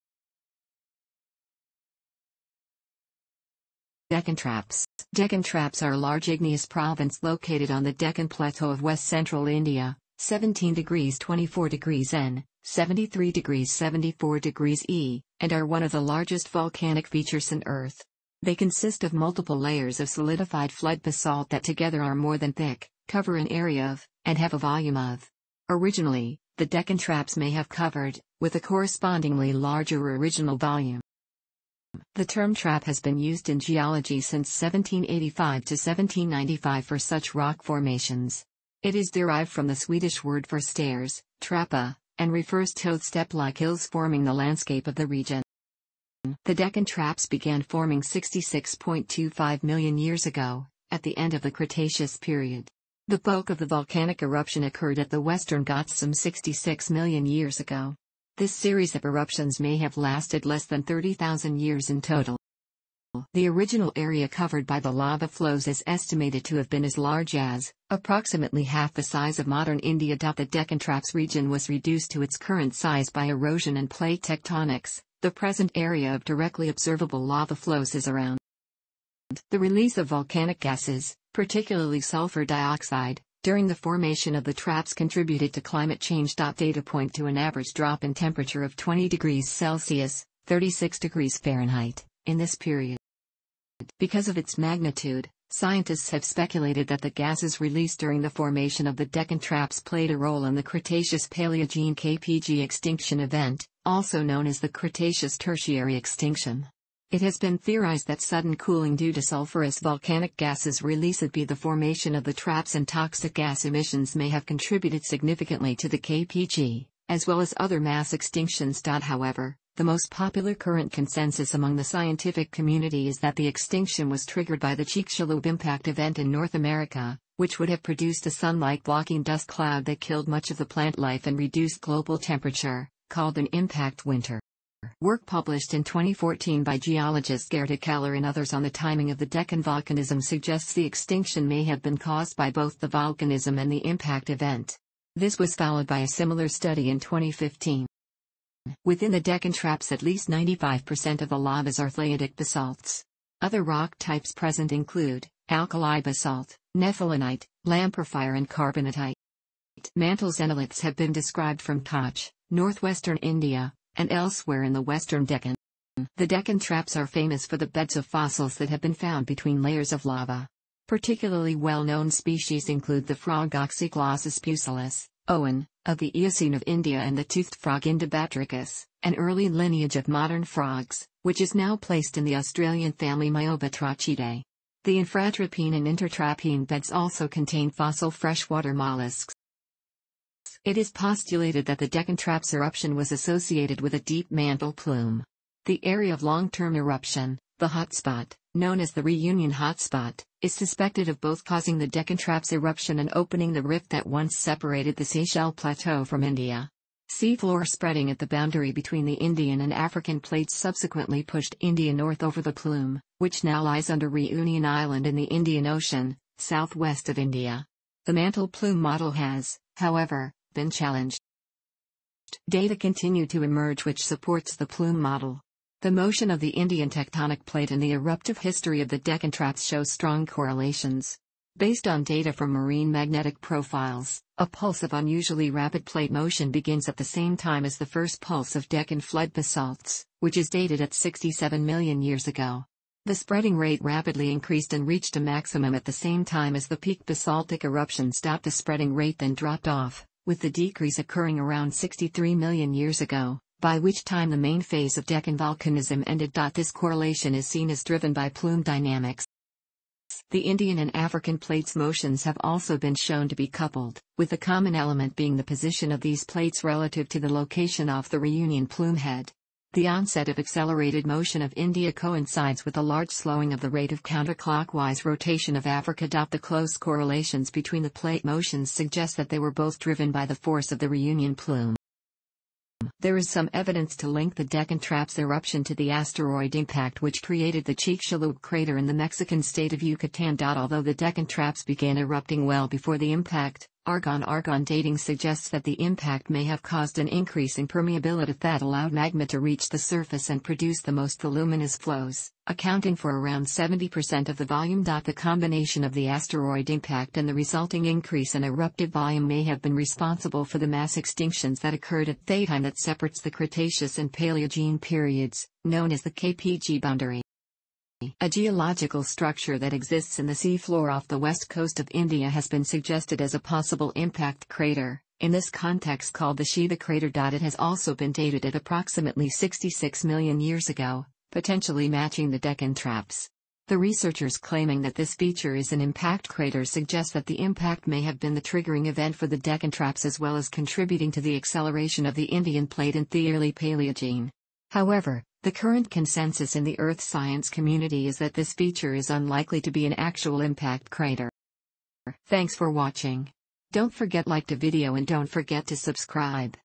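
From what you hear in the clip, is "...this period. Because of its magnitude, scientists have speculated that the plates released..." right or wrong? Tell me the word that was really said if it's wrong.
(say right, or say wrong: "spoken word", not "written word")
wrong: "gases", not "plates".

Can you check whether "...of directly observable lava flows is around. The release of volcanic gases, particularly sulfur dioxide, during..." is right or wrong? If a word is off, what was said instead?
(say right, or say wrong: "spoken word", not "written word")
right.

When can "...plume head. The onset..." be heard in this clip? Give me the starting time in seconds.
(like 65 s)
268 s.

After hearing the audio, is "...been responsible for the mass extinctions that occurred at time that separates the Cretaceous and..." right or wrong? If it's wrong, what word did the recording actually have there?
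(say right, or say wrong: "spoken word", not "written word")
right.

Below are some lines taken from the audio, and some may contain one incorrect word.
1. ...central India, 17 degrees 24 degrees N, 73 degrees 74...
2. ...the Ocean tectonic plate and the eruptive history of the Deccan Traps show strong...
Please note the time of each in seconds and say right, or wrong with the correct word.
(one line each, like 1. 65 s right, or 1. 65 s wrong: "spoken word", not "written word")
1. 9 s right
2. 226 s wrong: "Indian", not "Ocean".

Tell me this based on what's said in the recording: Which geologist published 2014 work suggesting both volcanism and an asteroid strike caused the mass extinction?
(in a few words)
Gerda Keller.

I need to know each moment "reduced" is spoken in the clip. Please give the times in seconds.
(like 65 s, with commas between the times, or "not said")
71 s, 131 s.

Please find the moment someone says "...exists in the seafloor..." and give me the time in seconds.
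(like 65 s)
319 s.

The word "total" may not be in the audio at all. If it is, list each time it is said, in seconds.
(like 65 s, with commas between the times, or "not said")
62 s.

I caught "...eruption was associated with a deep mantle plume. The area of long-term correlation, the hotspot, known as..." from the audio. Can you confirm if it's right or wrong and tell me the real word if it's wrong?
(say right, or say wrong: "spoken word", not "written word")
wrong: "eruption", not "correlation".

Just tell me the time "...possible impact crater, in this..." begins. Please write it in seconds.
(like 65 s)
323 s.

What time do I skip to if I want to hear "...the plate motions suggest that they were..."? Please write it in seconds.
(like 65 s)
277 s.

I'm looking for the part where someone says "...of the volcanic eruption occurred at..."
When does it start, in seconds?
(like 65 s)
53 s.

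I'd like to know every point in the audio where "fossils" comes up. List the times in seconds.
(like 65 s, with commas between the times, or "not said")
168 s, 187 s.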